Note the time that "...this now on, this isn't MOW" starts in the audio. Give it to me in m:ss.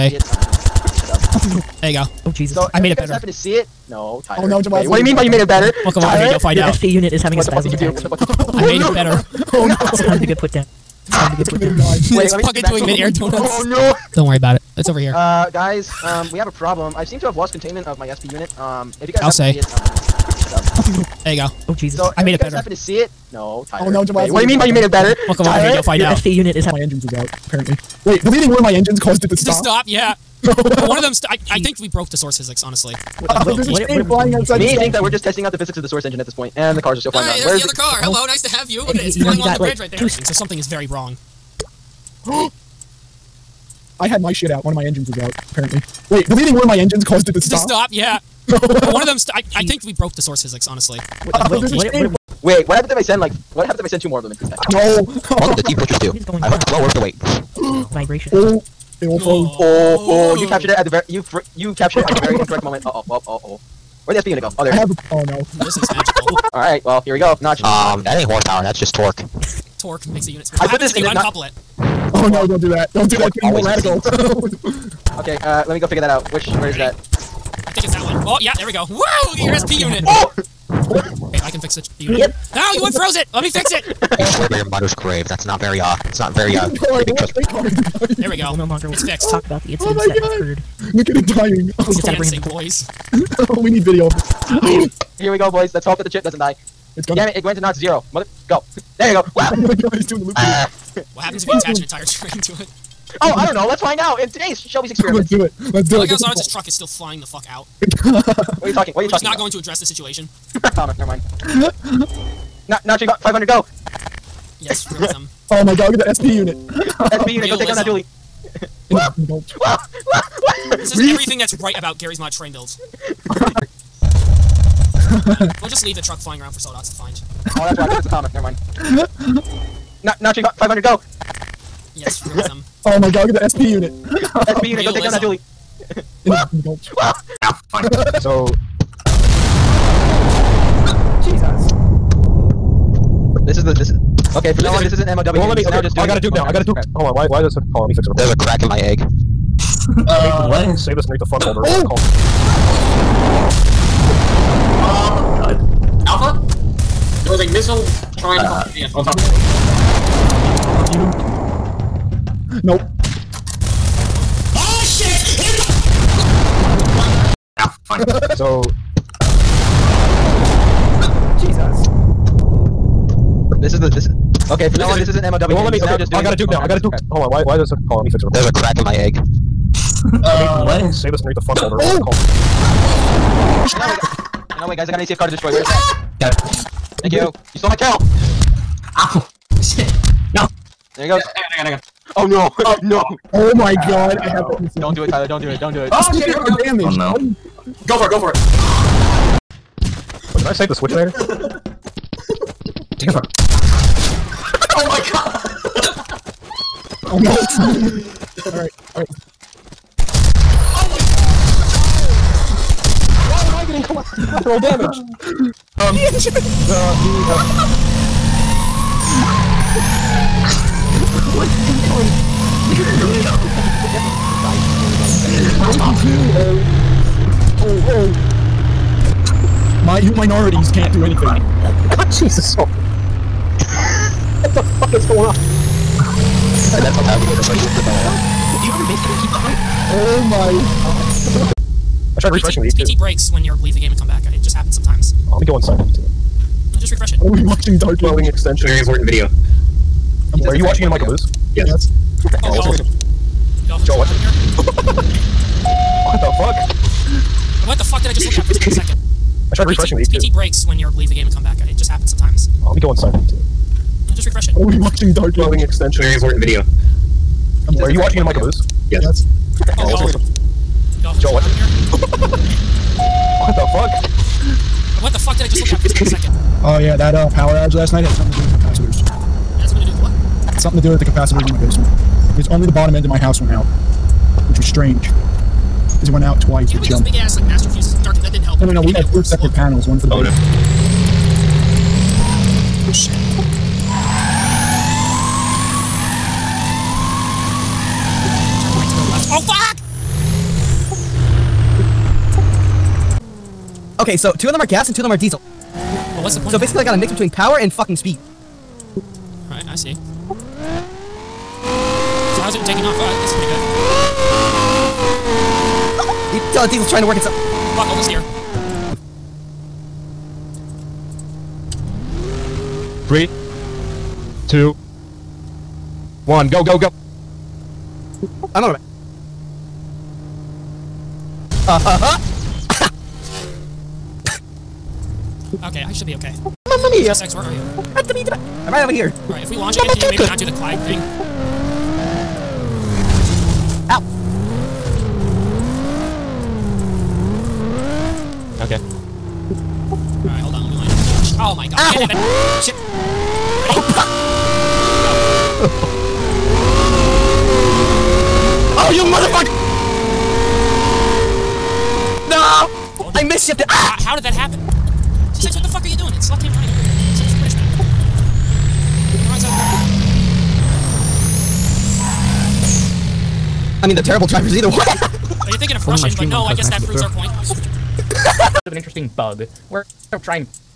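2:54.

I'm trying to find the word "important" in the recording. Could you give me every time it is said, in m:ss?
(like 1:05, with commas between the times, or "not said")
4:08, 4:26.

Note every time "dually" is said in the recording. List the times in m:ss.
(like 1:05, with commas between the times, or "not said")
1:57, 2:15.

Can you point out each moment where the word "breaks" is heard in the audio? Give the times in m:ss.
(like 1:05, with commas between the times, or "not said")
4:02, 4:20.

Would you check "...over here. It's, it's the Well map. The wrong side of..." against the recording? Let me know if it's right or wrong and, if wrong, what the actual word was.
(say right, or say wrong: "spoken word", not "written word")
wrong: "British", not "Well".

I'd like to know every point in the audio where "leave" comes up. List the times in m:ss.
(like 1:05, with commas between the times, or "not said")
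2:05, 4:03, 4:20.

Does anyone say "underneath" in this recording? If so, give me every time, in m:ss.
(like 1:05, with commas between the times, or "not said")
2:31, 3:01.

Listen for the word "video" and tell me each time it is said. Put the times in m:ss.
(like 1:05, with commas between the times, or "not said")
1:33, 4:09, 4:26.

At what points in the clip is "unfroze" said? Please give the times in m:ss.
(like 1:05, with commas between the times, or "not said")
1:22.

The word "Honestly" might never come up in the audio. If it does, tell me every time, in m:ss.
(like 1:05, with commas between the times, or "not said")
0:32, 0:50.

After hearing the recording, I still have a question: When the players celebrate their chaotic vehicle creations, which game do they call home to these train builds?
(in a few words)
Garry's Mod.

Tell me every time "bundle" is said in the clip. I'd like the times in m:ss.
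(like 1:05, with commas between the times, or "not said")
not said.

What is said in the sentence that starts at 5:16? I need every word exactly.
You tell the diesel's trying to work itself.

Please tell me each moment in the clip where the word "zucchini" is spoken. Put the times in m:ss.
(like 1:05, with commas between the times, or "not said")
not said.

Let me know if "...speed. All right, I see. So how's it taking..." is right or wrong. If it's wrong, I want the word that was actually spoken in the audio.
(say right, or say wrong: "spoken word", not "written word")
right.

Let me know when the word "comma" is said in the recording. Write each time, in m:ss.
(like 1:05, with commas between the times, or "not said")
1:50, 2:08.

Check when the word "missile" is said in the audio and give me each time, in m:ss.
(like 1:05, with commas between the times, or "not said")
2:37.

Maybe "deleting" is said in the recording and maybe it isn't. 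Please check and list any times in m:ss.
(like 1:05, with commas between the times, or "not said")
0:28, 0:46.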